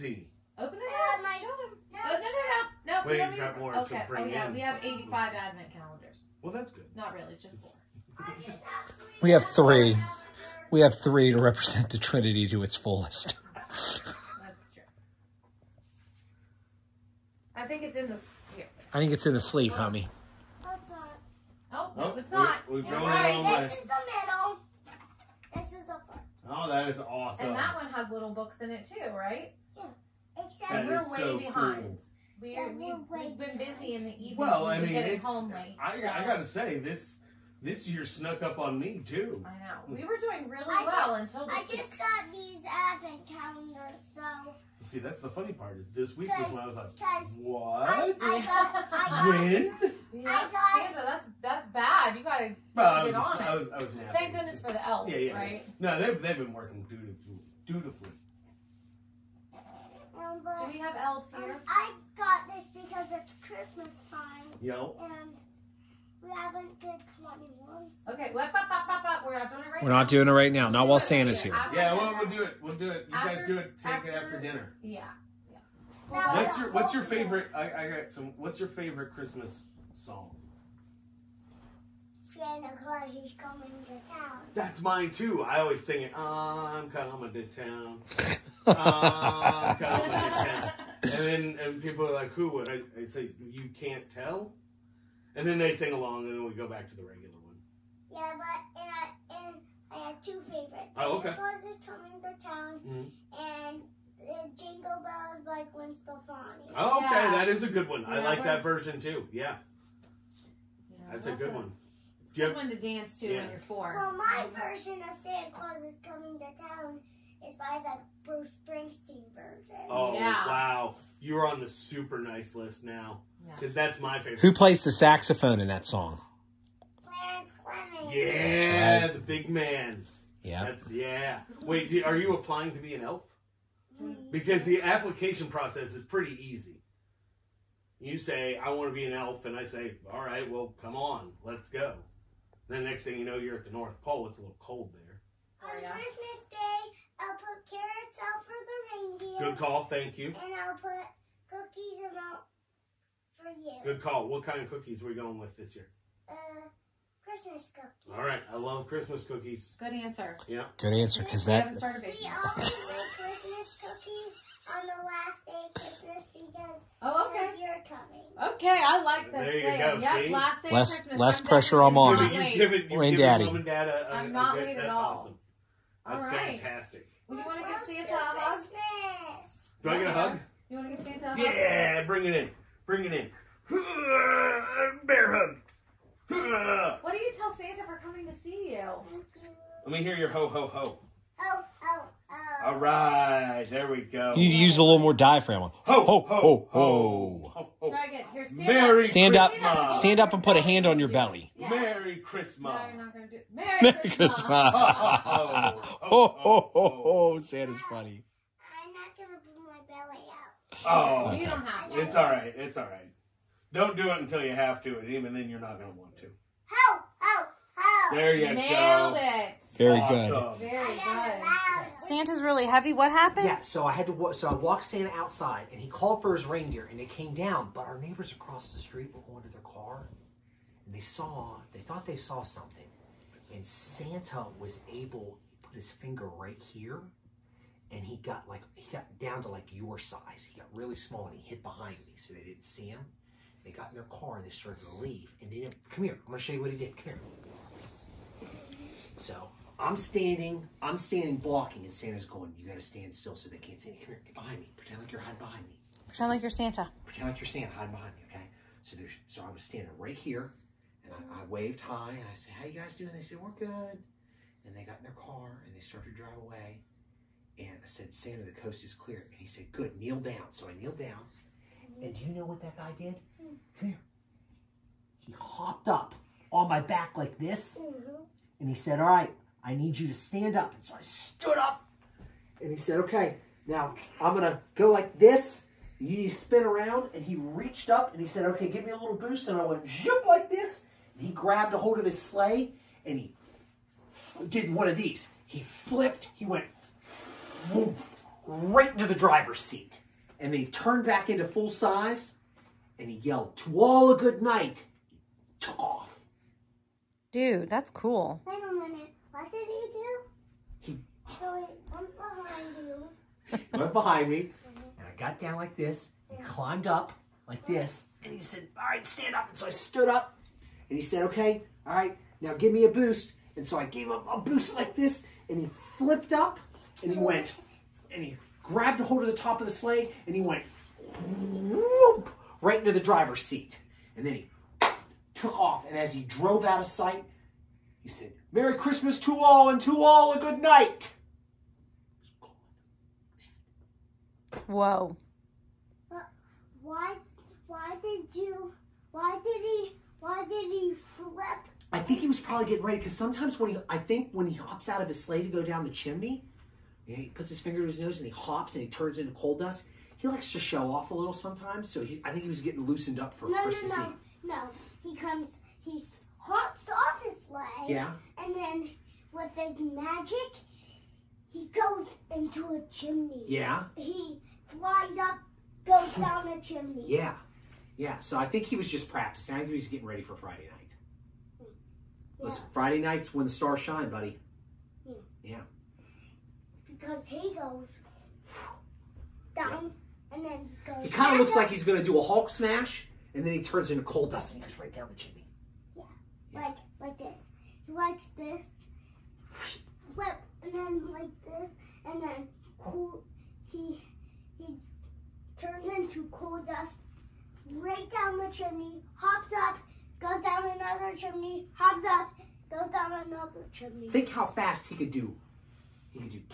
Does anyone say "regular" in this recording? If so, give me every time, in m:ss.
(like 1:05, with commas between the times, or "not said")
1:37.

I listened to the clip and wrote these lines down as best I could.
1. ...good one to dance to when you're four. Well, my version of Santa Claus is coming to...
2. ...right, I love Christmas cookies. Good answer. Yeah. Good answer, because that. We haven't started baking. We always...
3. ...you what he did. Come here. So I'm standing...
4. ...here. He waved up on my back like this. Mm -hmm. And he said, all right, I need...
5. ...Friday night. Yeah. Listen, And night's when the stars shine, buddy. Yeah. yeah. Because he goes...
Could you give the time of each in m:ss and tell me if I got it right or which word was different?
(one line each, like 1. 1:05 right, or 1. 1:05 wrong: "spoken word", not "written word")
1. 1:52 right
2. 2:38 right
3. 4:06 right
4. 4:33 wrong: "hopped", not "waved"
5. 6:20 wrong: "Friday", not "And".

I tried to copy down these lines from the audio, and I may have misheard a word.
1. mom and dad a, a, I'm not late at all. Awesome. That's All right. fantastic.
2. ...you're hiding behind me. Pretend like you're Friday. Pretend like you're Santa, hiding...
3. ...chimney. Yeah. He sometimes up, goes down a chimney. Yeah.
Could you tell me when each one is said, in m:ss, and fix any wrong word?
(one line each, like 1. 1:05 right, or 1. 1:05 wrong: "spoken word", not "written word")
1. 2:53 right
2. 4:15 wrong: "Santa", not "Friday"
3. 6:12 wrong: "flies", not "sometimes".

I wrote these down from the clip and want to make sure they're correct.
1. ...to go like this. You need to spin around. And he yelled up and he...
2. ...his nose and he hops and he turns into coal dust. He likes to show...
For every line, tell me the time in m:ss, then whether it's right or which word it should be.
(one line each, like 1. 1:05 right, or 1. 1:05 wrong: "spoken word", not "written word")
1. 4:44 wrong: "reached", not "yelled"
2. 5:57 right.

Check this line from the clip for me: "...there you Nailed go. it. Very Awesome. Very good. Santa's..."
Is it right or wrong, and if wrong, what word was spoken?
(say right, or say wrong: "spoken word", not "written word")
right.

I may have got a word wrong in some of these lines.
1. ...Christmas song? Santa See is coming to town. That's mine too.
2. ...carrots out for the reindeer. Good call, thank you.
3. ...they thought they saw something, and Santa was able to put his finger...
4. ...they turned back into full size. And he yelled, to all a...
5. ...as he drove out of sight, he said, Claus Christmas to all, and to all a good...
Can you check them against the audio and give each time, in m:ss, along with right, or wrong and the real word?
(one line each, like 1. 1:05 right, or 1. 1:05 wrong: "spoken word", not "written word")
1. 1:19 wrong: "Claus", not "See"
2. 2:27 right
3. 3:51 right
4. 5:00 right
5. 5:35 wrong: "Merry", not "Claus".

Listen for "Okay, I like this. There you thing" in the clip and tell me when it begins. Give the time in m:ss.
2:48.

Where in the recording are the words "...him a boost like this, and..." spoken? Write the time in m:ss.
5:24.